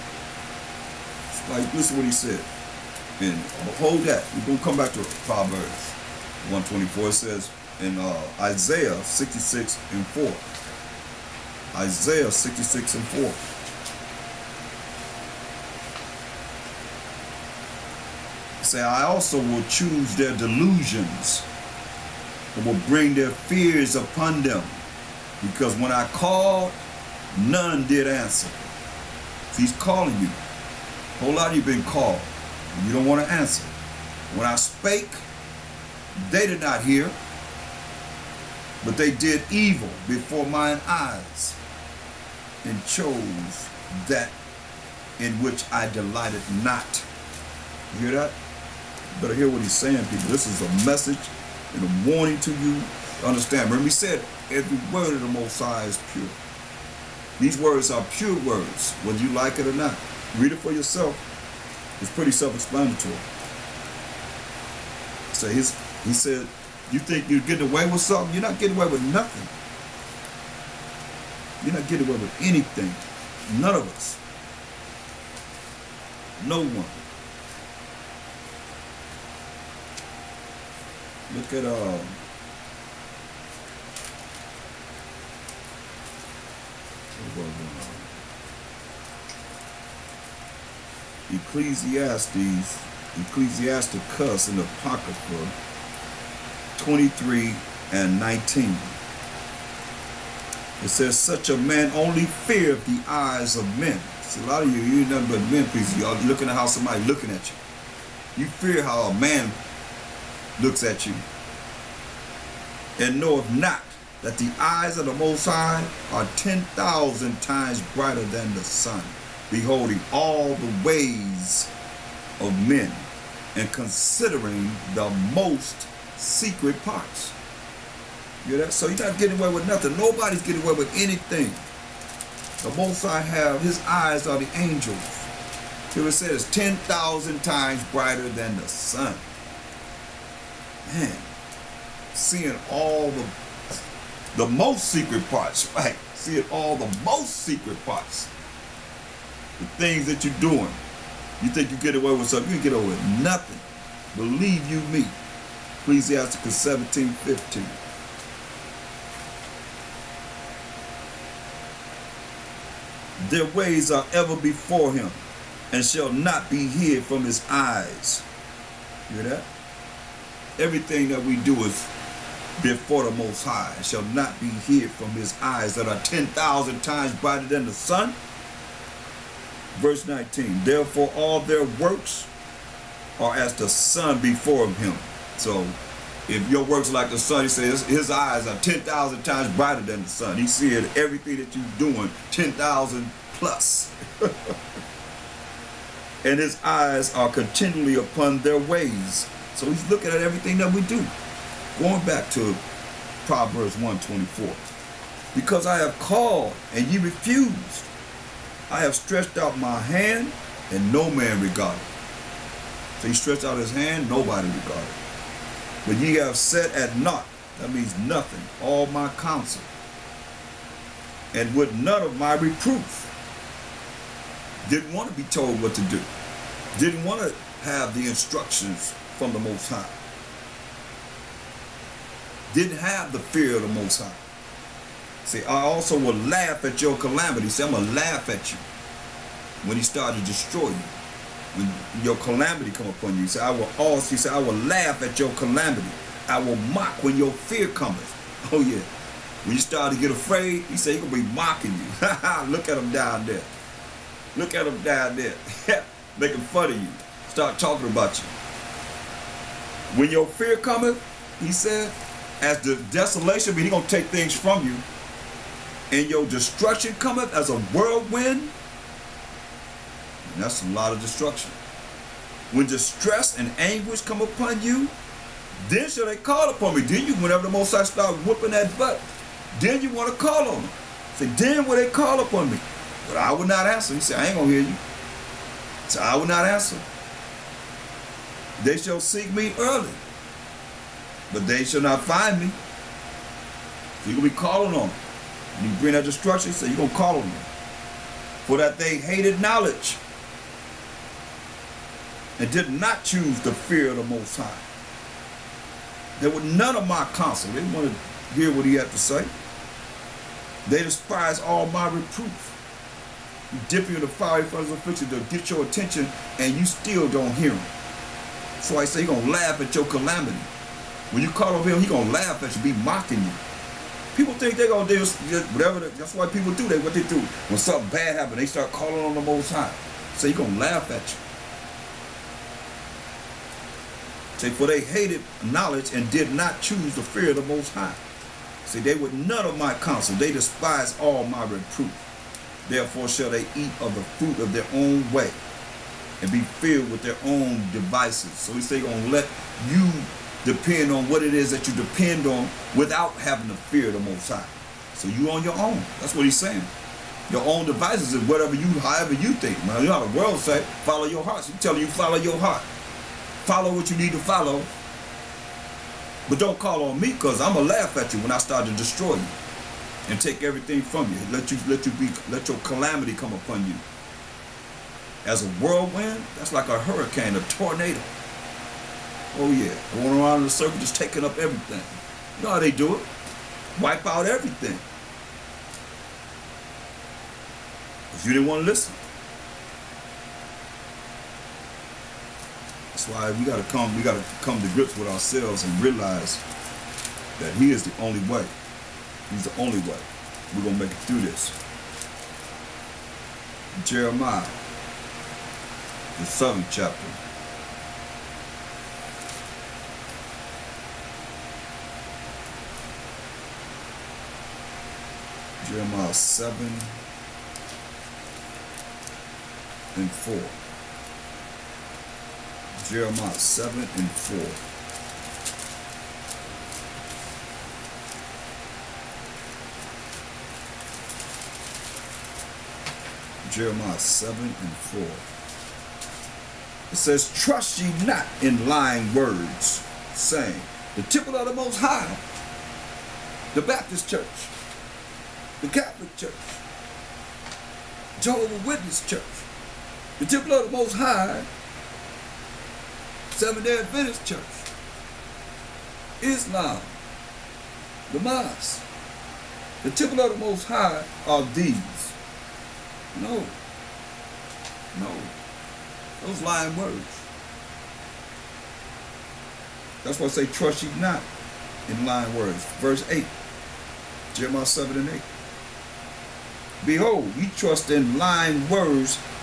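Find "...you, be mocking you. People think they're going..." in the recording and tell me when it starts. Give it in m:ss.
5:22.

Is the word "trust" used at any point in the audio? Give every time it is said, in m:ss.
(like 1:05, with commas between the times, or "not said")
7:17, 7:50, 7:57.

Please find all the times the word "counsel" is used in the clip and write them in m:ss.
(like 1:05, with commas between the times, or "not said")
3:39, 5:07, 5:39.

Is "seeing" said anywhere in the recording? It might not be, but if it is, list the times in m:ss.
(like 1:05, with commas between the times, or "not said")
2:22, 2:26.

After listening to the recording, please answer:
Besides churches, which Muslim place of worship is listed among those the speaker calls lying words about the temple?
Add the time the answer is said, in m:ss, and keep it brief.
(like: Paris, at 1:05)
The mosque, at 7:38.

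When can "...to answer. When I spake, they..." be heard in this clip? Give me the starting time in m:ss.
0:33.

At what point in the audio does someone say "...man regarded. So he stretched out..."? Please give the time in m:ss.
3:31.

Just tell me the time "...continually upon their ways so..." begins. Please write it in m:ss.
3:17.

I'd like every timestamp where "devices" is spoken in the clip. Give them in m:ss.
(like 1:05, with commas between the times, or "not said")
5:47, 5:57.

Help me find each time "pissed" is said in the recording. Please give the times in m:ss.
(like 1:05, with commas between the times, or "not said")
not said.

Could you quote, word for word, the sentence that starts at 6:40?
We're gonna make it through this.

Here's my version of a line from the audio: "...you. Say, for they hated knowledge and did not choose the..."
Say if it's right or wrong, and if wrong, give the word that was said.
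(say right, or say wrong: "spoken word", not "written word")
right.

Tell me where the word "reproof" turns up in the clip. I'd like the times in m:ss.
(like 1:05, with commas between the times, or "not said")
3:42, 5:11, 5:41.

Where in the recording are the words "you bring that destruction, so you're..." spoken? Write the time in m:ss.
4:55.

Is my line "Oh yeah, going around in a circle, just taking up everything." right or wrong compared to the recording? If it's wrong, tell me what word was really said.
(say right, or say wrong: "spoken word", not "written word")
right.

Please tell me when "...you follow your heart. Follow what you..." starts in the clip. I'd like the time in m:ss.
6:01.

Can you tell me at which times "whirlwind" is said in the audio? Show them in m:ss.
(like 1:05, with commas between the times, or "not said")
4:27, 6:15.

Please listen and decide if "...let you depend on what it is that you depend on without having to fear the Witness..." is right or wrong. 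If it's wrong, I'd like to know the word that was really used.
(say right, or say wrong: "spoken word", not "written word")
wrong: "Most", not "Witness".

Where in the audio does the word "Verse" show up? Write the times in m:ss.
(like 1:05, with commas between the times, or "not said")
2:59, 7:52.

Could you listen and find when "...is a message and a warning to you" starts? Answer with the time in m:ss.
0:50.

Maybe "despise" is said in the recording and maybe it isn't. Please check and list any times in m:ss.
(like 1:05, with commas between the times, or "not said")
5:10, 5:40.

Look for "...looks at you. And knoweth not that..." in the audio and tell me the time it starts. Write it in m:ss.
1:50.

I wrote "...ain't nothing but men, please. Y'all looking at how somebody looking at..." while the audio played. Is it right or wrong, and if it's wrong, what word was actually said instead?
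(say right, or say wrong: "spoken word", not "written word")
right.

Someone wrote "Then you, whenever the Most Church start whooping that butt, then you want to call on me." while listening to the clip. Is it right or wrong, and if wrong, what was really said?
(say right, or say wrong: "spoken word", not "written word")
wrong: "High", not "Church".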